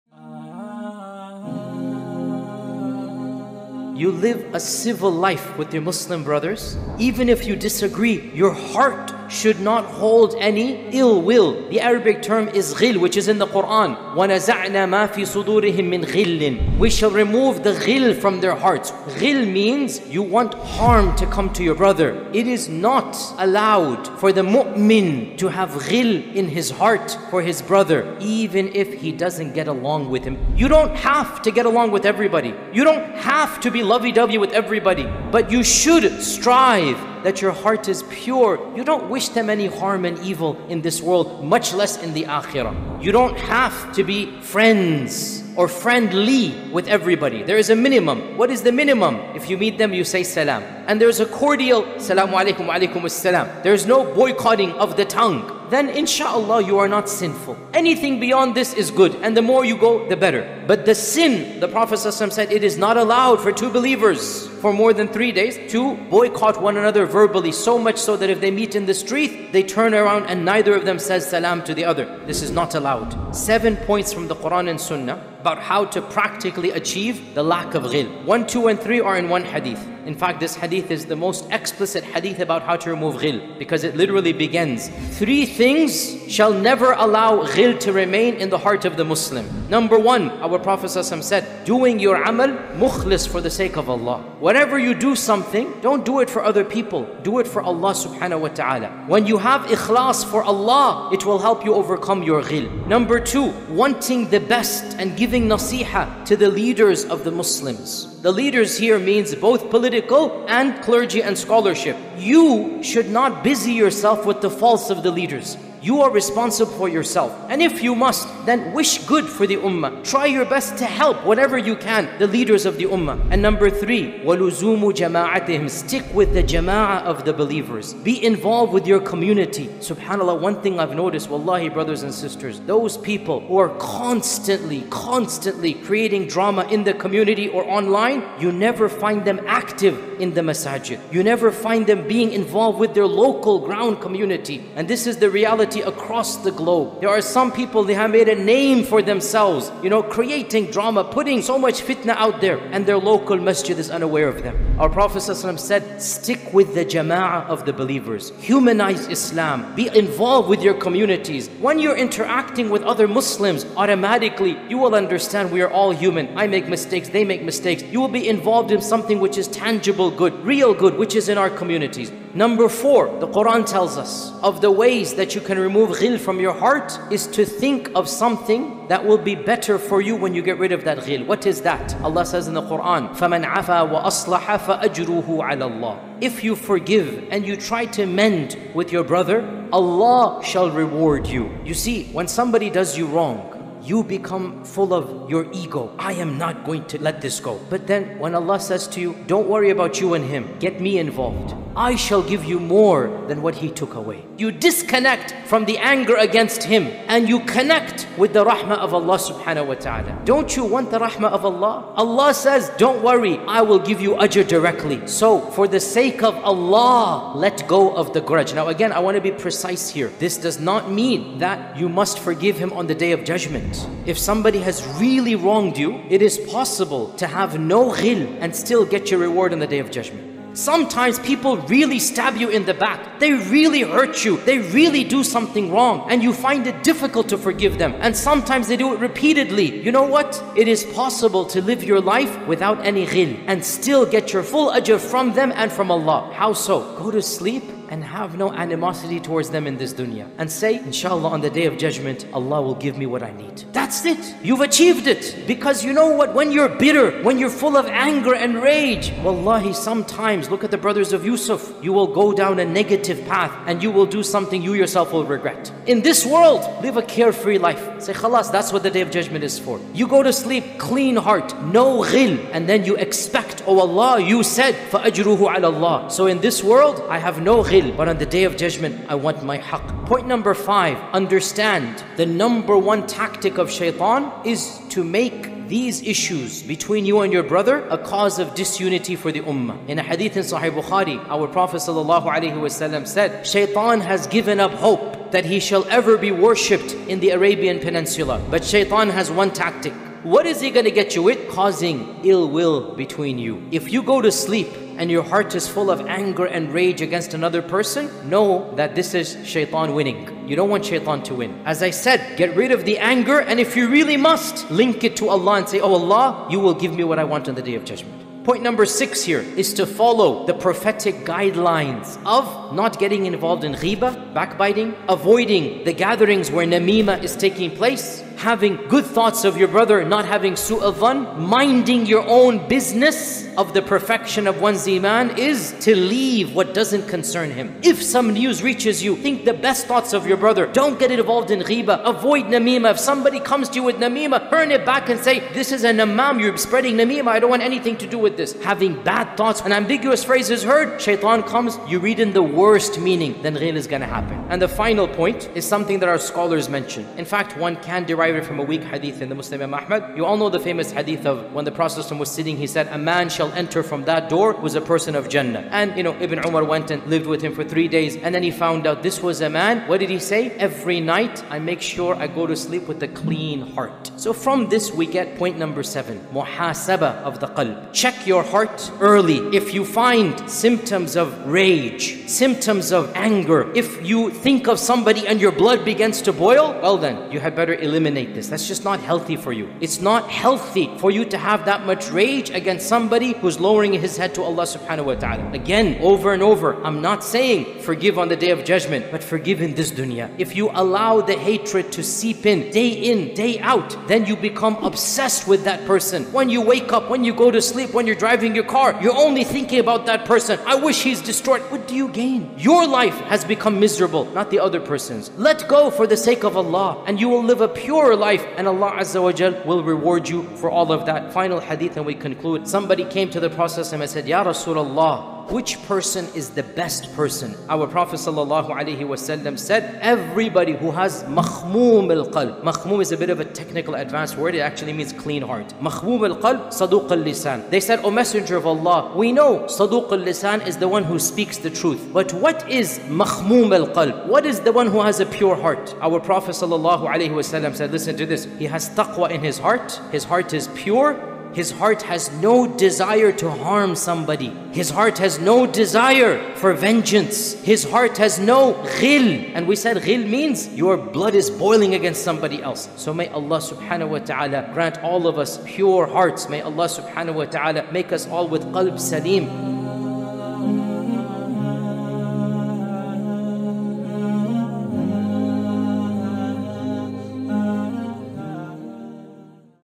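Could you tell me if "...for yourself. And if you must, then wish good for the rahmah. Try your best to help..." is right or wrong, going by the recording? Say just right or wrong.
wrong.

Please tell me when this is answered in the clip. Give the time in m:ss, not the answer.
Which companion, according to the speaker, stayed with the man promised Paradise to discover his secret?
6:06.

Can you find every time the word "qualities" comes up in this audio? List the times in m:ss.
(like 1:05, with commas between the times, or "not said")
not said.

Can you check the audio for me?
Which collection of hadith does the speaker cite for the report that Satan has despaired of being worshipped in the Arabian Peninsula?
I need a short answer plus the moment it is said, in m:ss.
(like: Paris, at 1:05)
Sahih Bukhari, at 4:50.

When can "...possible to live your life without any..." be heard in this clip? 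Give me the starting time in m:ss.
4:00.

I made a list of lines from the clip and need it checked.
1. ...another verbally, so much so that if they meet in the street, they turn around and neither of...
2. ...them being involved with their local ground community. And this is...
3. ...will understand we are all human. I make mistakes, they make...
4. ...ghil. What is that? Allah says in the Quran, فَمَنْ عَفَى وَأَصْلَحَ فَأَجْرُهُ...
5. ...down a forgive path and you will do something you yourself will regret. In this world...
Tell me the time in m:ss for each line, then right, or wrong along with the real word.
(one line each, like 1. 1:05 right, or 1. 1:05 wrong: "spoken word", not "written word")
1. 1:06 right
2. 2:21 right
3. 2:44 right
4. 3:01 right
5. 4:22 wrong: "negative", not "forgive".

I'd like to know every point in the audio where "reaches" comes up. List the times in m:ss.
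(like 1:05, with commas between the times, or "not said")
5:38.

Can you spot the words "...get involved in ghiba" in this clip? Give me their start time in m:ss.
5:40.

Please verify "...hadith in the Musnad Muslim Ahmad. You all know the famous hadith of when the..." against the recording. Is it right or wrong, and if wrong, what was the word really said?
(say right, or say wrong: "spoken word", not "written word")
wrong: "Imam", not "Muslim".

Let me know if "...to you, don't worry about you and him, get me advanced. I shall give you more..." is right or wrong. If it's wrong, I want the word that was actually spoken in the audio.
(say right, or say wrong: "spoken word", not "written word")
wrong: "involved", not "advanced".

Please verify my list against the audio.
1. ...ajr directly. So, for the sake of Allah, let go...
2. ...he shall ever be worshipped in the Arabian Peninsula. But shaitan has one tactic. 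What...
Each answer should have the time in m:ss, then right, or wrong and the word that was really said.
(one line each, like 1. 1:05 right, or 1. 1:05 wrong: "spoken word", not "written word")
1. 3:34 right
2. 4:55 right.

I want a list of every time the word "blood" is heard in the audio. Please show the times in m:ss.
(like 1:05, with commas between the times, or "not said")
6:25, 7:40.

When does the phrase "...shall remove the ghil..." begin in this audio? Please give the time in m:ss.
0:16.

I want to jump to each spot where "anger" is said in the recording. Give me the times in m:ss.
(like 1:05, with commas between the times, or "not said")
3:25, 4:17, 5:06, 5:12, 6:23.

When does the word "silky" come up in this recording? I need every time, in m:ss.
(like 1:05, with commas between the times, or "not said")
not said.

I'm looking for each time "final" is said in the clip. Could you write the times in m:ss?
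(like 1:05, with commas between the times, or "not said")
5:54, 7:01.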